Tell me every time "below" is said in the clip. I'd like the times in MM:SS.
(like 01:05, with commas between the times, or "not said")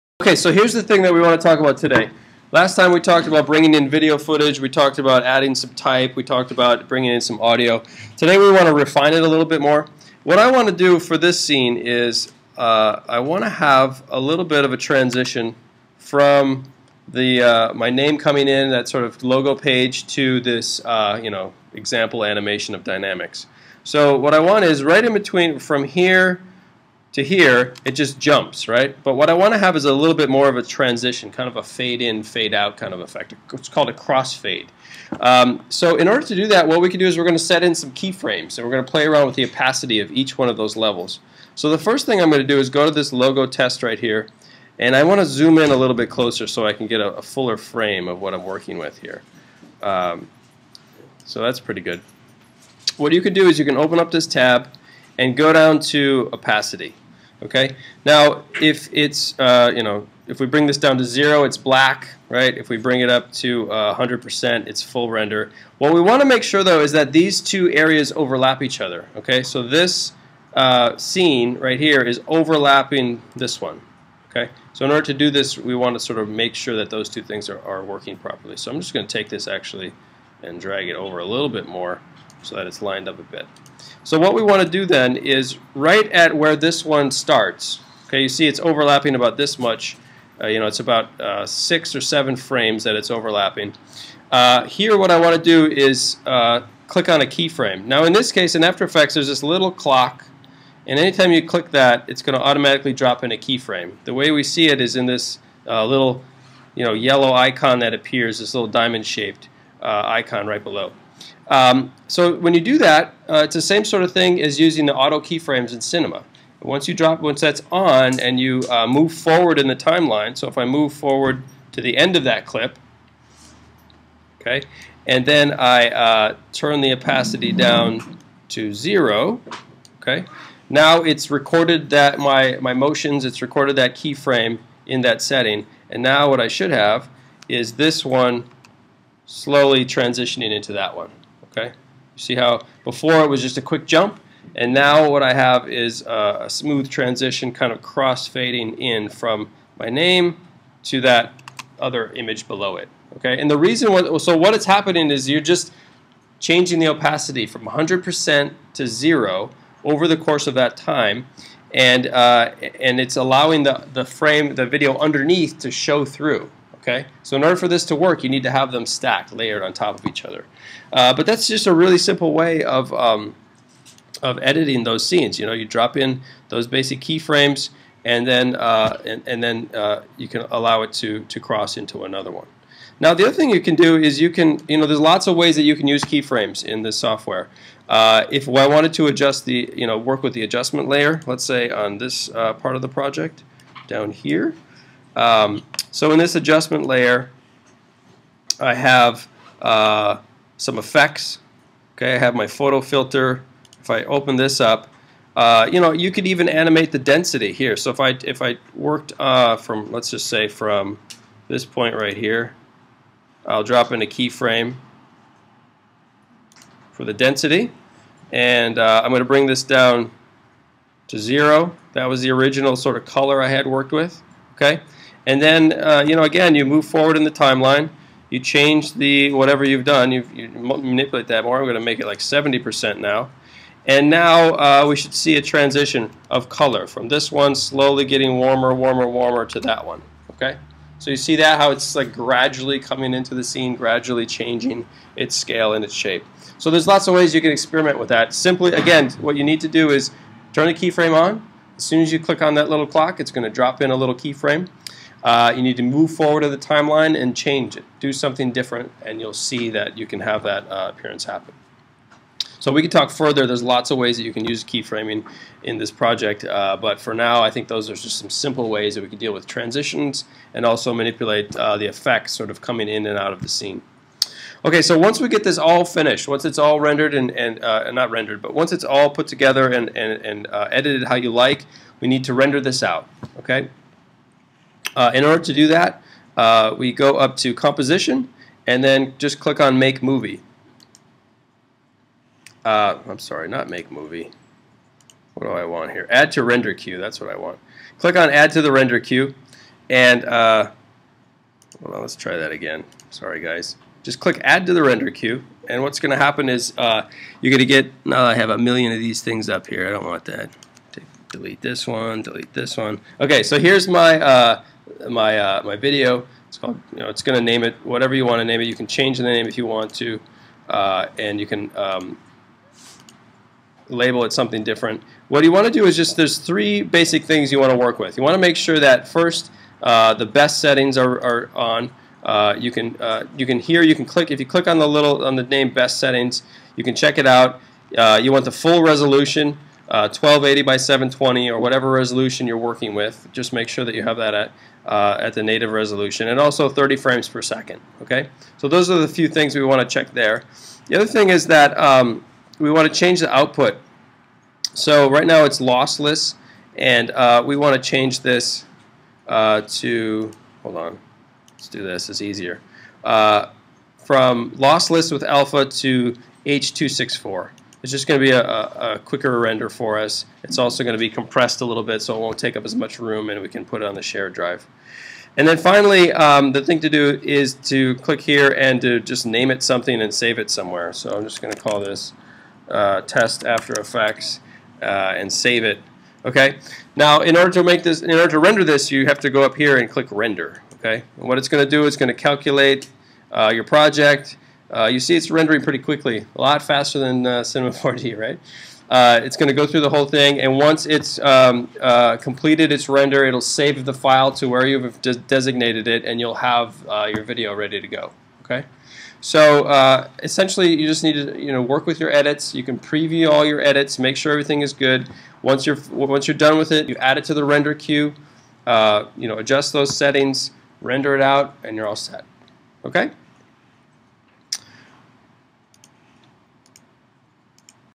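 01:50, 02:32.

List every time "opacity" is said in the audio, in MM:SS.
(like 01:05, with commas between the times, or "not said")
00:39, 00:56, 02:06, 02:36.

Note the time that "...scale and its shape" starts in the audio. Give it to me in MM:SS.
04:05.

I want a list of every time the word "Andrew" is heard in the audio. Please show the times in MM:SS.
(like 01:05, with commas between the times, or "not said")
not said.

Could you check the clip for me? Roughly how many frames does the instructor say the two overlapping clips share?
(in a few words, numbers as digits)
6 or 7.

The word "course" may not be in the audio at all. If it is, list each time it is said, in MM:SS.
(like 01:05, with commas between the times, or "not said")
02:40.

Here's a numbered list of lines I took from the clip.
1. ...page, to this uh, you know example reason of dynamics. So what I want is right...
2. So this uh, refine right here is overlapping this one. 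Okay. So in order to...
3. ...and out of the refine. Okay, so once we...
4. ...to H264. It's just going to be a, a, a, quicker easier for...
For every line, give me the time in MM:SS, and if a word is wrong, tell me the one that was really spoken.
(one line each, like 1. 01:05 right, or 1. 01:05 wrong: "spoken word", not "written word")
1. 00:19 wrong: "animation", not "reason"
2. 01:09 wrong: "scene", not "refine"
3. 04:33 wrong: "scene", not "refine"
4. 06:05 wrong: "render", not "easier".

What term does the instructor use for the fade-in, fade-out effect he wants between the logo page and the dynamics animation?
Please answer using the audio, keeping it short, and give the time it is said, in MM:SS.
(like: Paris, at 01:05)
Crossfade, at 00:33.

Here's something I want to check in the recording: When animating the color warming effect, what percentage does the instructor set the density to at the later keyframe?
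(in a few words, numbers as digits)
70%.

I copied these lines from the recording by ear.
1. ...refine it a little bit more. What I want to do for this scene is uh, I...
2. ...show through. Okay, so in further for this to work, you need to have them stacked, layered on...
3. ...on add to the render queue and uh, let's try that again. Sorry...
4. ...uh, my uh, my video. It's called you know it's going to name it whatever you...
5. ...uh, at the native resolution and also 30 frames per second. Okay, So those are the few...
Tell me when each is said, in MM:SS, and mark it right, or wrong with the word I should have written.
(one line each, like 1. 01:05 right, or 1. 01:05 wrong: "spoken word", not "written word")
1. 00:08 right
2. 02:45 wrong: "order", not "further"
3. 04:58 right
4. 05:14 right
5. 05:44 right.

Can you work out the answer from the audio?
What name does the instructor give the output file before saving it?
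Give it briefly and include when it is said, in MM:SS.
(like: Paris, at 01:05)
test After Effects, at 06:23.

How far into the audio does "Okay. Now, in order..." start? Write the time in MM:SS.
06:26.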